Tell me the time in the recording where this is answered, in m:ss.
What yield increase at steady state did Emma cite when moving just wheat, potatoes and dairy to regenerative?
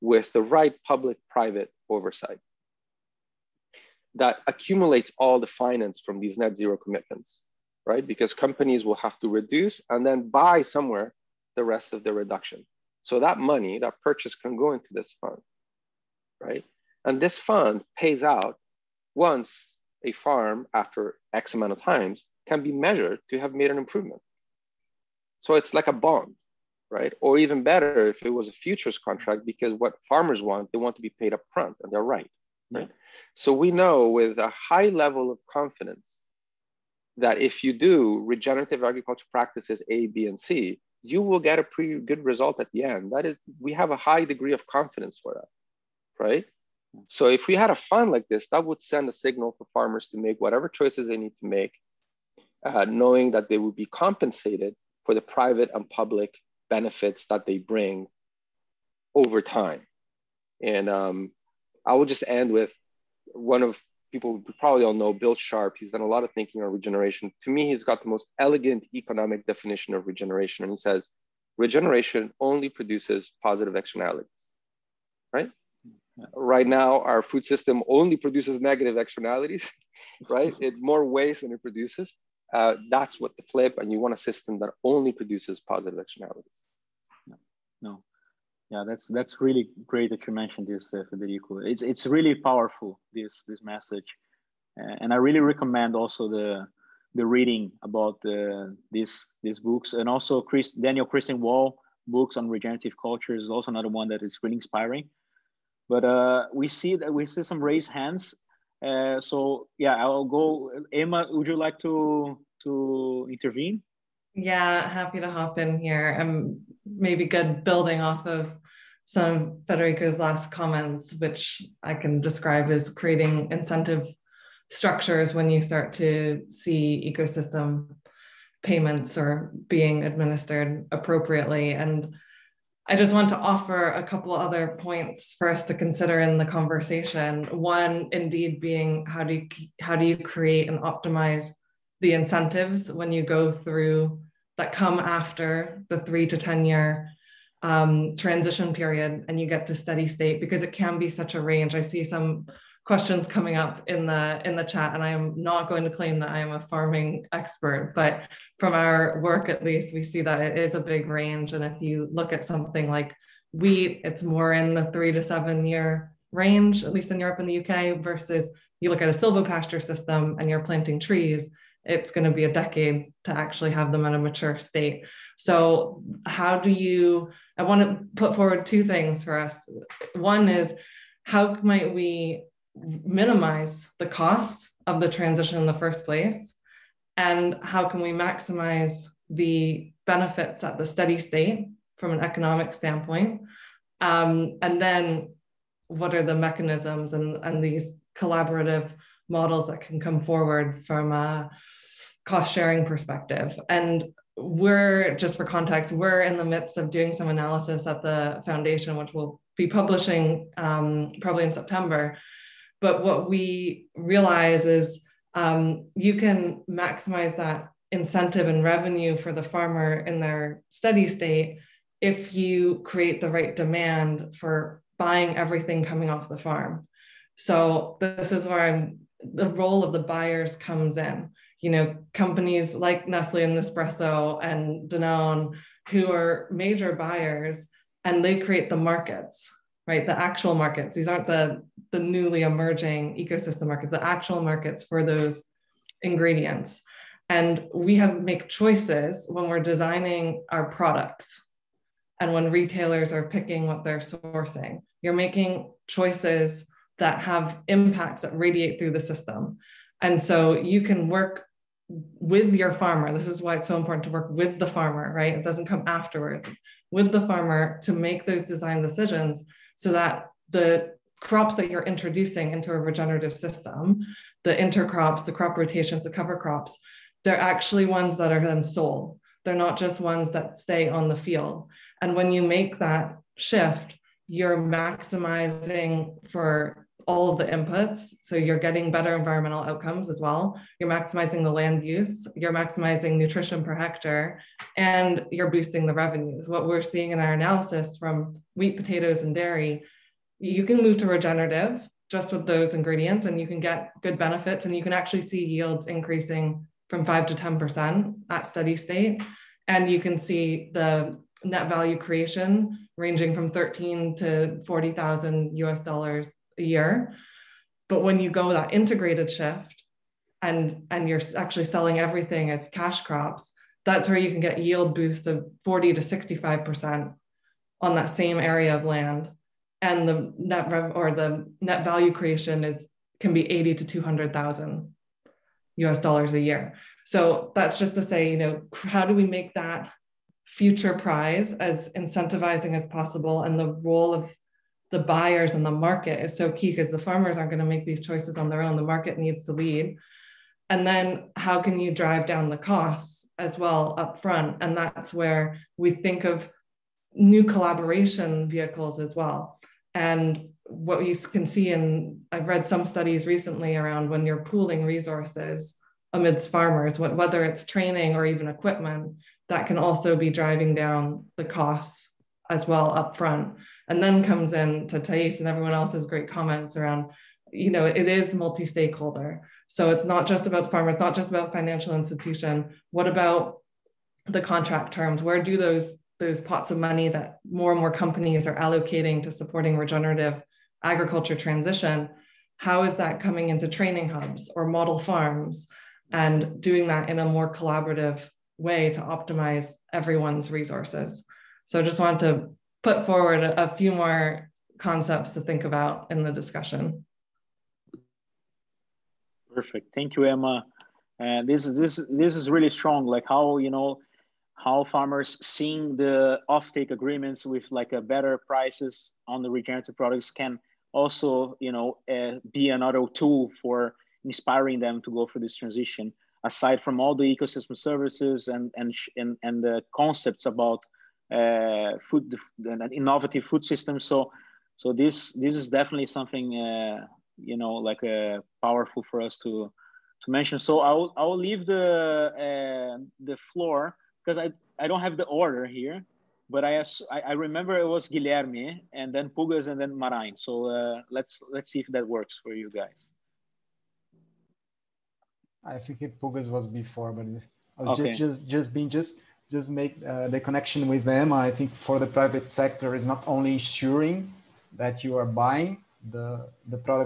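5:07.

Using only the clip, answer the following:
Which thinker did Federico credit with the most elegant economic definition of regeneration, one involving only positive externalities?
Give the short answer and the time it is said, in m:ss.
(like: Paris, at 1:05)
Bill Sharp, at 1:05.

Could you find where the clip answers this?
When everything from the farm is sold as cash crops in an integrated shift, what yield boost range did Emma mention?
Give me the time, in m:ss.
5:25.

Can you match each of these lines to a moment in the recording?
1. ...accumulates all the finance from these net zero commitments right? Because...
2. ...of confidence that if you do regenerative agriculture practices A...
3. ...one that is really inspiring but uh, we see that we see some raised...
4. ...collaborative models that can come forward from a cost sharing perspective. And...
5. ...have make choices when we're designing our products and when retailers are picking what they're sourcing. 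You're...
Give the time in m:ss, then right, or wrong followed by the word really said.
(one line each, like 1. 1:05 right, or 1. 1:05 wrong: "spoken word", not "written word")
1. 0:04 right
2. 0:35 right
3. 1:43 right
4. 3:18 right
5. 4:07 right.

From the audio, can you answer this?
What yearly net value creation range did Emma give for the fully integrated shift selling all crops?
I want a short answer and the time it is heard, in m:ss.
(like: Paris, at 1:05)
80,000 to 200,000 US dollars, at 5:33.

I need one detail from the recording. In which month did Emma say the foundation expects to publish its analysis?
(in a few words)
September.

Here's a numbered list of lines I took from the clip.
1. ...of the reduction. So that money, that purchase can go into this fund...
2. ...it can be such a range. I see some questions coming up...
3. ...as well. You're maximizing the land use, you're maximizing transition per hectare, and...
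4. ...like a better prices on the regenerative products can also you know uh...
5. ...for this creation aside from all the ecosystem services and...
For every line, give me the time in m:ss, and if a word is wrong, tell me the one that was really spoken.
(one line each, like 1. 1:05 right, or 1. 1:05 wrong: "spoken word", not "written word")
1. 0:11 right
2. 2:30 right
3. 4:50 wrong: "nutrition", not "transition"
4. 6:57 right
5. 7:05 wrong: "transition", not "creation".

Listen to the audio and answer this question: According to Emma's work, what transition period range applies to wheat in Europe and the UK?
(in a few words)
3 to 7 years.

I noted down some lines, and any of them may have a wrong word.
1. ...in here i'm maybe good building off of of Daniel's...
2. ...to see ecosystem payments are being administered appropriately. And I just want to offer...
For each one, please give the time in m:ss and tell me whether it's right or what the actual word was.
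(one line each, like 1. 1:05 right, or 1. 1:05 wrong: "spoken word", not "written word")
1. 1:55 wrong: "Federico", not "Daniel"
2. 2:05 right.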